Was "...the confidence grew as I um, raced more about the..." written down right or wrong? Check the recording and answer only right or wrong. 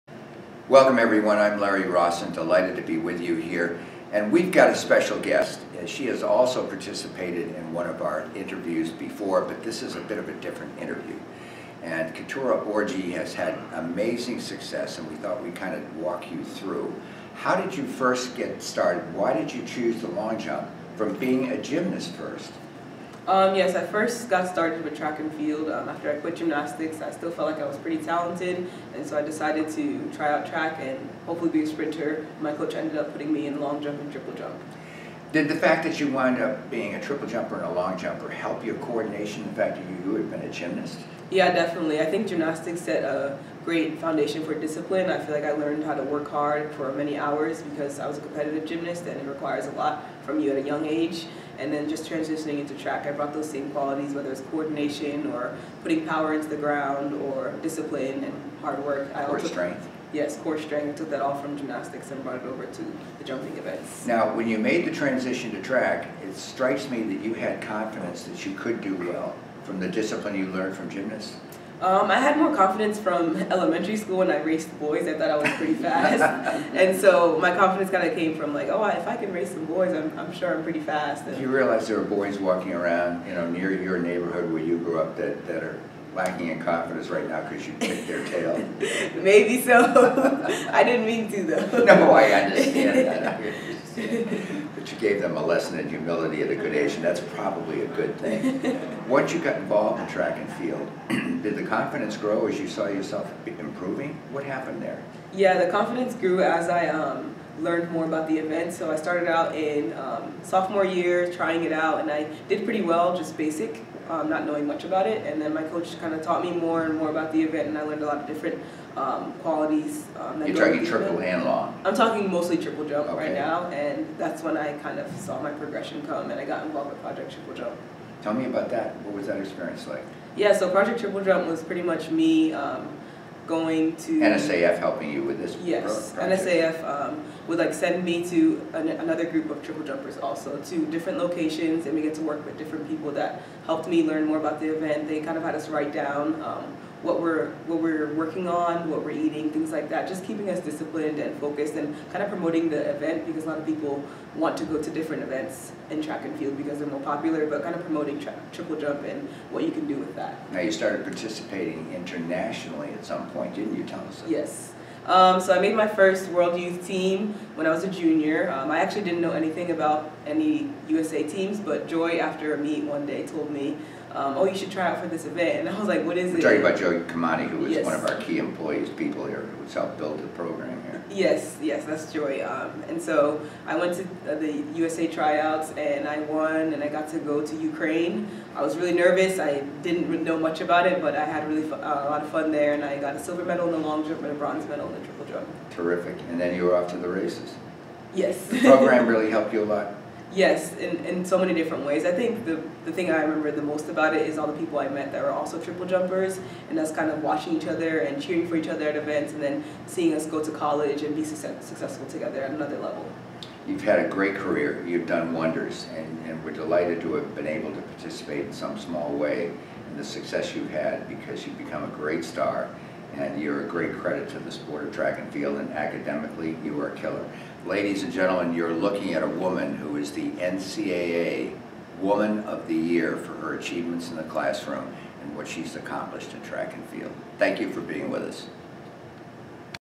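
wrong.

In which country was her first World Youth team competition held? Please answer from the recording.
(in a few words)
Ukraine.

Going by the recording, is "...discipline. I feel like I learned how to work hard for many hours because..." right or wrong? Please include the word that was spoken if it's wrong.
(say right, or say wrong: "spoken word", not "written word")
right.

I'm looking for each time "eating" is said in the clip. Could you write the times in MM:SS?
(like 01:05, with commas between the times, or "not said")
02:29.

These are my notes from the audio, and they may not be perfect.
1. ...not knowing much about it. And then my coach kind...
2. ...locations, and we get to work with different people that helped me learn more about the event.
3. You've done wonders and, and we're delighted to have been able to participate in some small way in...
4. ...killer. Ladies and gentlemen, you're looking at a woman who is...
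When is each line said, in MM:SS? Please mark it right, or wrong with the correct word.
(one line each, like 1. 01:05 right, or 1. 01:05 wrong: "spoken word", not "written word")
1. 01:54 right
2. 02:21 right
3. 03:34 right
4. 03:46 right.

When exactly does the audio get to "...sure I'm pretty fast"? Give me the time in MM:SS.
01:20.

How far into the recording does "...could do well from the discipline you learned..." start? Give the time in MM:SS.
01:08.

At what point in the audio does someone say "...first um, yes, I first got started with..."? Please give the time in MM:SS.
00:22.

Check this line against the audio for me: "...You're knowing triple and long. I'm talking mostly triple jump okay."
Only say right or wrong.
wrong.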